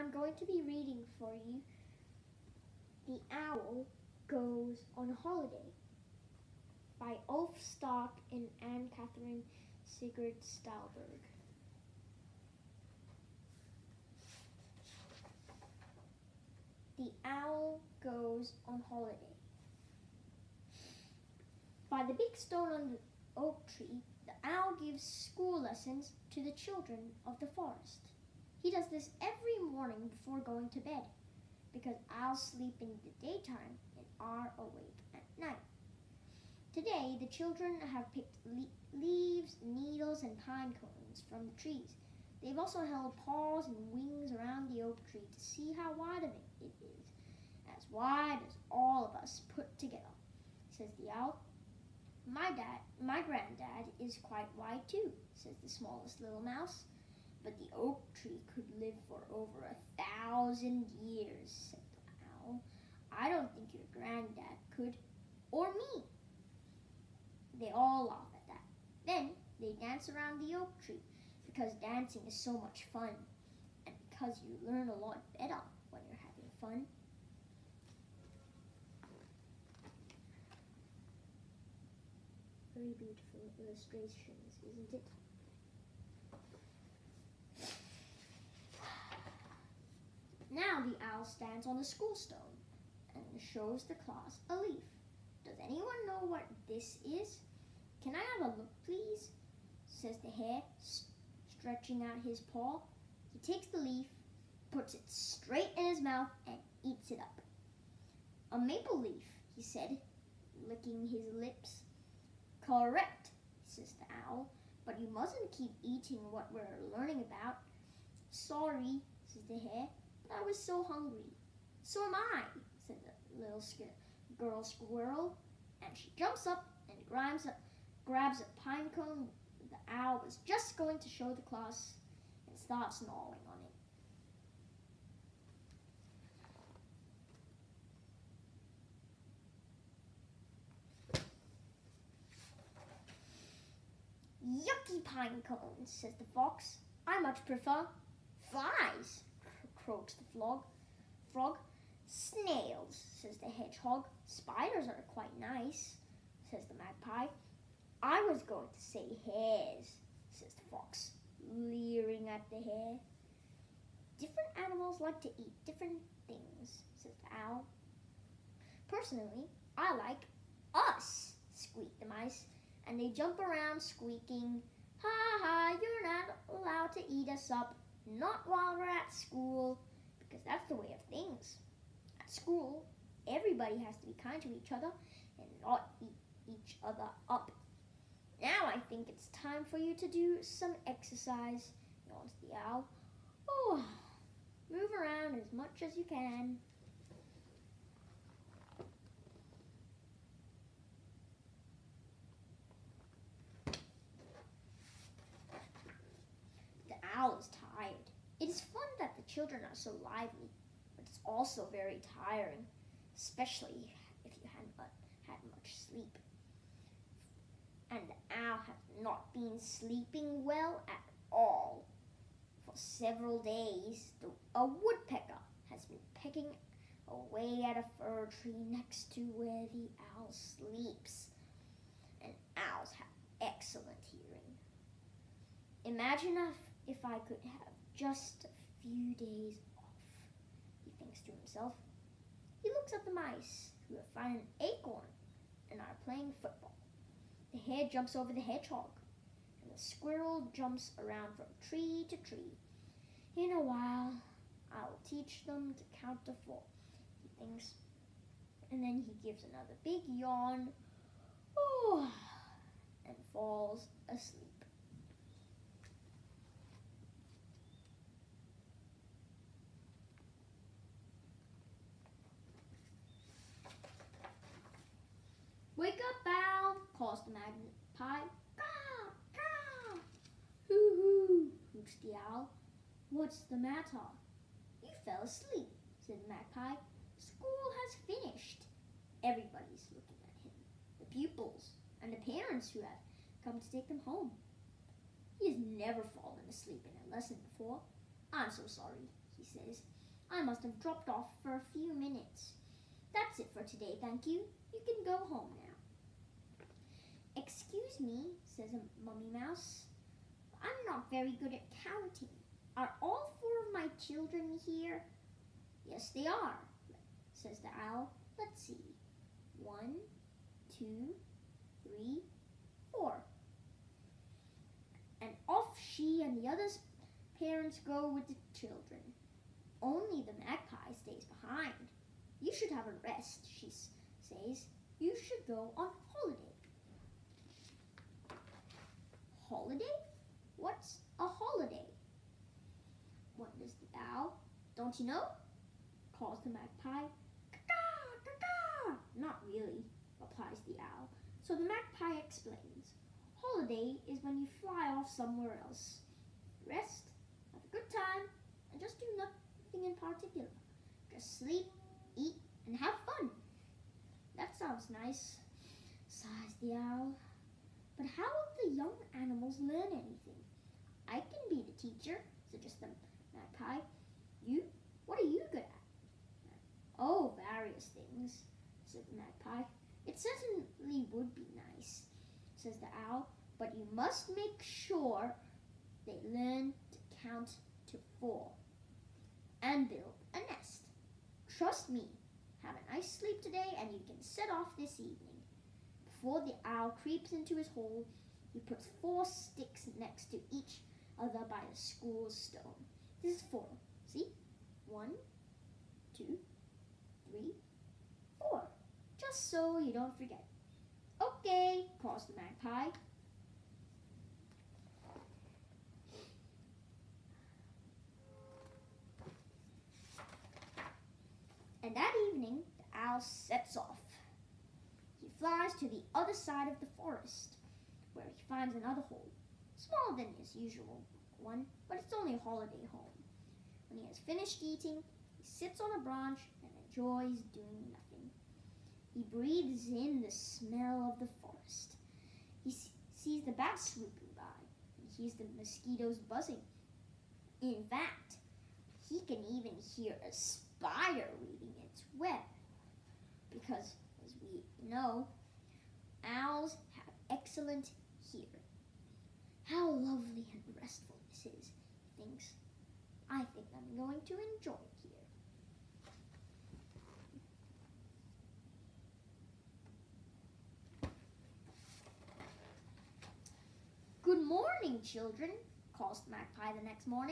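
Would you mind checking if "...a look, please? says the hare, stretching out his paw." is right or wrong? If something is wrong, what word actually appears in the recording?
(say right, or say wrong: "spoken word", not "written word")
right.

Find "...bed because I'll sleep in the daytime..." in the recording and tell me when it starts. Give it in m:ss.
0:30.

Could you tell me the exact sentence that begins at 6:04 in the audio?
That sounds nice, sighs the owl young animals learn anything.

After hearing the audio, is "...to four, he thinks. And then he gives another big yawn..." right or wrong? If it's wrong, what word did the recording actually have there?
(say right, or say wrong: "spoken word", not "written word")
right.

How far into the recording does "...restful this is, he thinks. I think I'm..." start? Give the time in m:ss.
7:40.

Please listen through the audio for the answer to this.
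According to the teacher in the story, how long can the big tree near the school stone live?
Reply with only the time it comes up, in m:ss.
0:59.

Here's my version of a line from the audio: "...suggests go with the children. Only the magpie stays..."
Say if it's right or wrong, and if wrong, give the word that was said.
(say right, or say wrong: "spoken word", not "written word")
wrong: "parents", not "suggests".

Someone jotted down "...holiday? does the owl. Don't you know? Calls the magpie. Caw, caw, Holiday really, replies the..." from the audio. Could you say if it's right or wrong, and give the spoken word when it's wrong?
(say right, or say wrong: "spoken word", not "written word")
wrong: "Not", not "Holiday".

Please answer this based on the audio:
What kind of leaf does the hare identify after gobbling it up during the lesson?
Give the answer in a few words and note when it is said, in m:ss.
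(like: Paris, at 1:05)
maple leaf, at 1:48.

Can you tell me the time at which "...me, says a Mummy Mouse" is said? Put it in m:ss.
5:08.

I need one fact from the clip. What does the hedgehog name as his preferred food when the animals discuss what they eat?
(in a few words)
snails.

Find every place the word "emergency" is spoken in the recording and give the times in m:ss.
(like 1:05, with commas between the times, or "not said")
not said.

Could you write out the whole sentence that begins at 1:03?
I don't think your granddad could, or me.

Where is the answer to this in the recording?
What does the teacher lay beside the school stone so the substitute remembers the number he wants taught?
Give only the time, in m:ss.
6:39.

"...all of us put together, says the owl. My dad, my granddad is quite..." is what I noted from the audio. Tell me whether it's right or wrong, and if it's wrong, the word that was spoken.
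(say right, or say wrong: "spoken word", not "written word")
right.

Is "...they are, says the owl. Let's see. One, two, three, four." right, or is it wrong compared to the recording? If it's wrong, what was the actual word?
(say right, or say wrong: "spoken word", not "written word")
right.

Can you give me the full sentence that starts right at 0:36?
Today, the children have picked le leaves, needles, and pine cones from the trees.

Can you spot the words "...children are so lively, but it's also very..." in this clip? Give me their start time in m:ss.
3:29.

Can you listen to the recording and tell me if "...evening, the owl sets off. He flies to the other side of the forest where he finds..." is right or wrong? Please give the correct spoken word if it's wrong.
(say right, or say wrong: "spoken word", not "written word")
right.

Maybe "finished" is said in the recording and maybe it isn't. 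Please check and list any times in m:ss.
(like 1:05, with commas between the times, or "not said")
4:48, 7:14.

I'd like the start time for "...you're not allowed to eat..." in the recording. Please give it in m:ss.
2:55.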